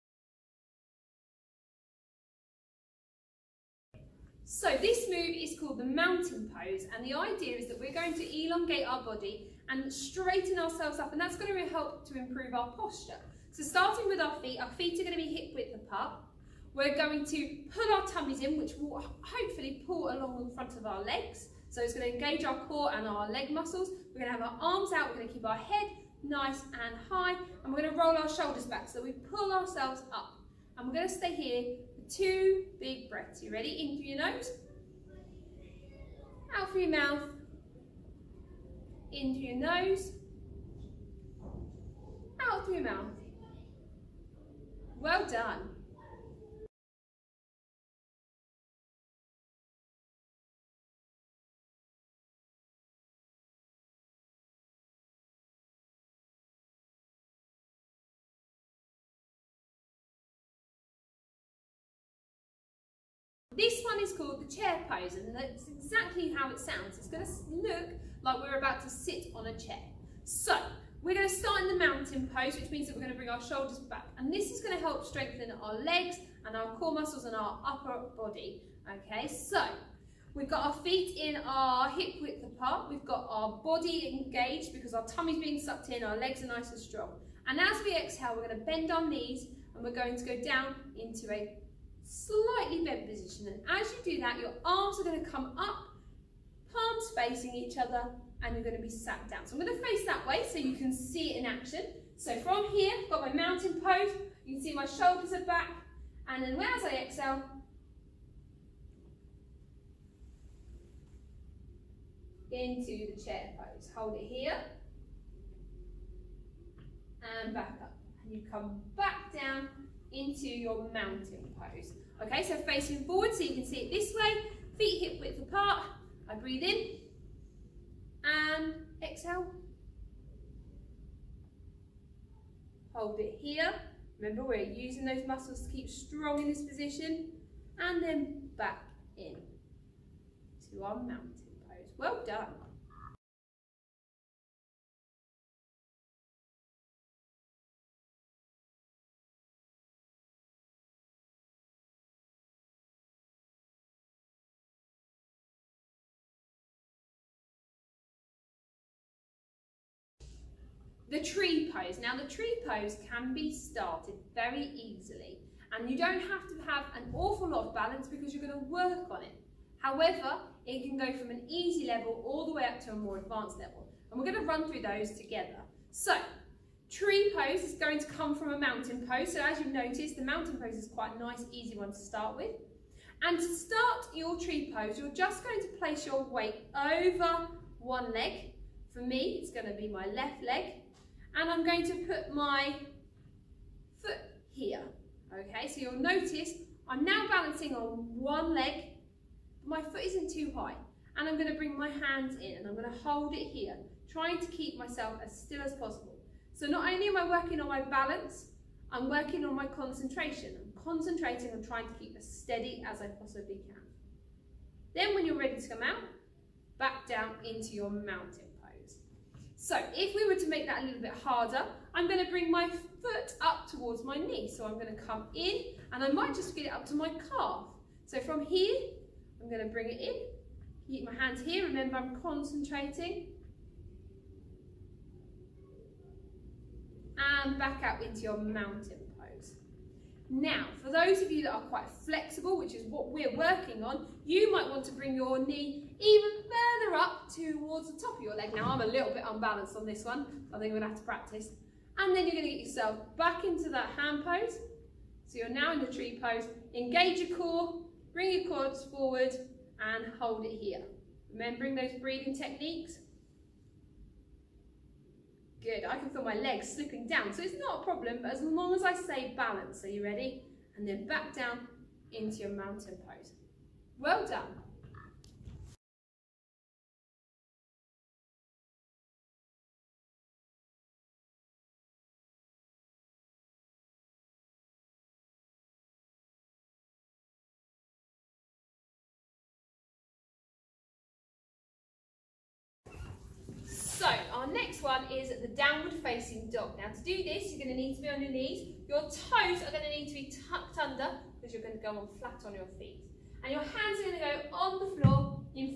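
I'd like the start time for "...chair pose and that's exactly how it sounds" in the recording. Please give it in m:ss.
1:04.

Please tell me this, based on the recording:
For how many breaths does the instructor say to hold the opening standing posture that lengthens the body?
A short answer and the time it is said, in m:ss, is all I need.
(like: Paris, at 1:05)
2, at 0:32.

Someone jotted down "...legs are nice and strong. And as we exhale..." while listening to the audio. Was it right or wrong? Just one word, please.
right.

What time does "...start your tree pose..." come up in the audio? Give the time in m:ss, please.
3:03.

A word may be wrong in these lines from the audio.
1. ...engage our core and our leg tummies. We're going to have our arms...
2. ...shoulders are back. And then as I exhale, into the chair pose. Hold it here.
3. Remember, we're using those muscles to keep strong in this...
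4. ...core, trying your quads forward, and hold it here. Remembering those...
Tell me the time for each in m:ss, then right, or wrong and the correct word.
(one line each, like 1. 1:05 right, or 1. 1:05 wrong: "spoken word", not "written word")
1. 0:22 wrong: "muscles", not "tummies"
2. 1:44 right
3. 2:14 right
4. 4:17 wrong: "bring", not "trying".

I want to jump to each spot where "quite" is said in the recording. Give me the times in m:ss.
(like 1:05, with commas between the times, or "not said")
3:00, 4:01.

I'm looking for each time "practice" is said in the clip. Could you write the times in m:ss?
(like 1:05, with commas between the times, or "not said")
4:11.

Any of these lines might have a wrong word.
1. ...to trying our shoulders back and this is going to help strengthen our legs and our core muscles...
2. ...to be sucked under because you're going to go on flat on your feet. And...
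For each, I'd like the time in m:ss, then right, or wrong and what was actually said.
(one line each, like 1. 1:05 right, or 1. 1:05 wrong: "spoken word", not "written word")
1. 1:13 wrong: "bring", not "trying"
2. 5:00 wrong: "tucked", not "sucked".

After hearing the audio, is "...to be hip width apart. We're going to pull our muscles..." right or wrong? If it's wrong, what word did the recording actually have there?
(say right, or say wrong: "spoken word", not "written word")
wrong: "tummies", not "muscles".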